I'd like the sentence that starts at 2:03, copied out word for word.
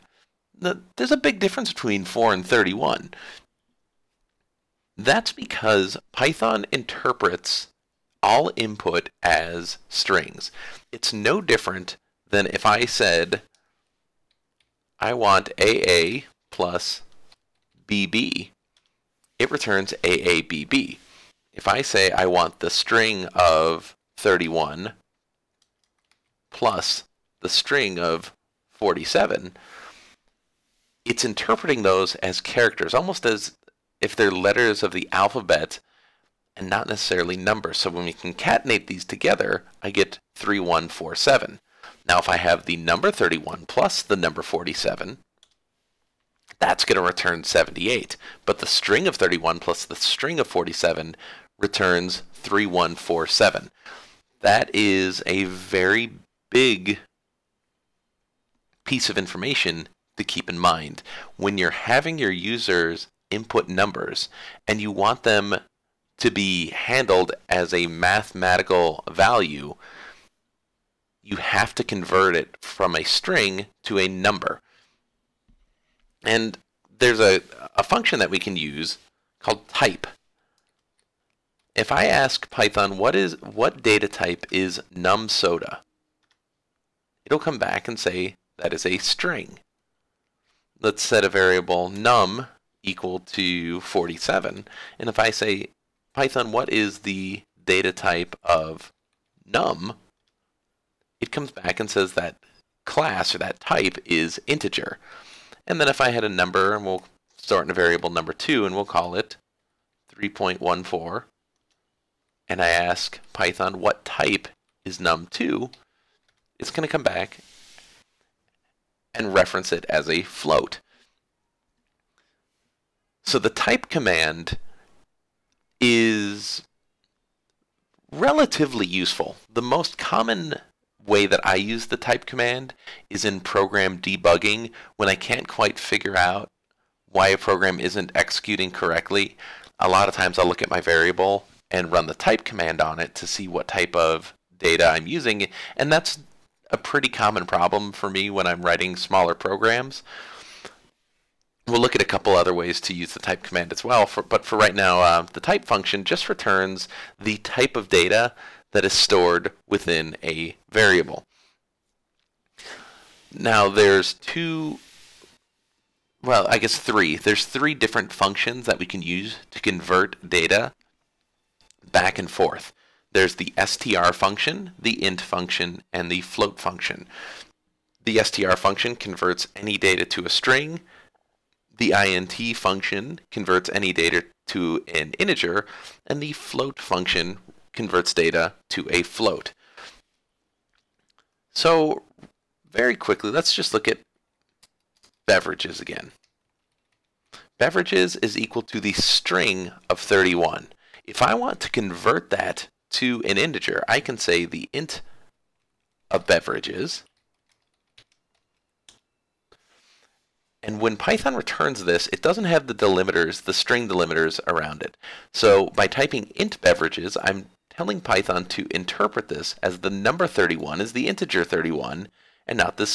So the type command is relatively useful.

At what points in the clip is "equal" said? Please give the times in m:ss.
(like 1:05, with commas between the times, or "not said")
1:32, 3:18.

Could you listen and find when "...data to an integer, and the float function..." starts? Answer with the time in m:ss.
3:03.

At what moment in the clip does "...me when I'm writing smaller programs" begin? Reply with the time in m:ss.
2:28.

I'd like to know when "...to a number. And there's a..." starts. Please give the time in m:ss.
1:13.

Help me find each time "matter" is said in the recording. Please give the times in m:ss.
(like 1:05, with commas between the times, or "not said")
not said.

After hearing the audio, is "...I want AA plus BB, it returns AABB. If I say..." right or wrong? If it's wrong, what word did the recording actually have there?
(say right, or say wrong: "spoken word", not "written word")
right.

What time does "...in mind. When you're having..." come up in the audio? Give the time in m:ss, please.
1:00.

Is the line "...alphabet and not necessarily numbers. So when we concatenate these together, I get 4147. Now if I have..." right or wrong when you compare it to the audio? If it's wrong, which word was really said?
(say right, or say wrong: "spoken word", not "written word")
wrong: "3147", not "4147".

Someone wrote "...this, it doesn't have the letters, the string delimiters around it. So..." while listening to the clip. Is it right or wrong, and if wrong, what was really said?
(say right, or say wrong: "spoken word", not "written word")
wrong: "delimiters", not "letters".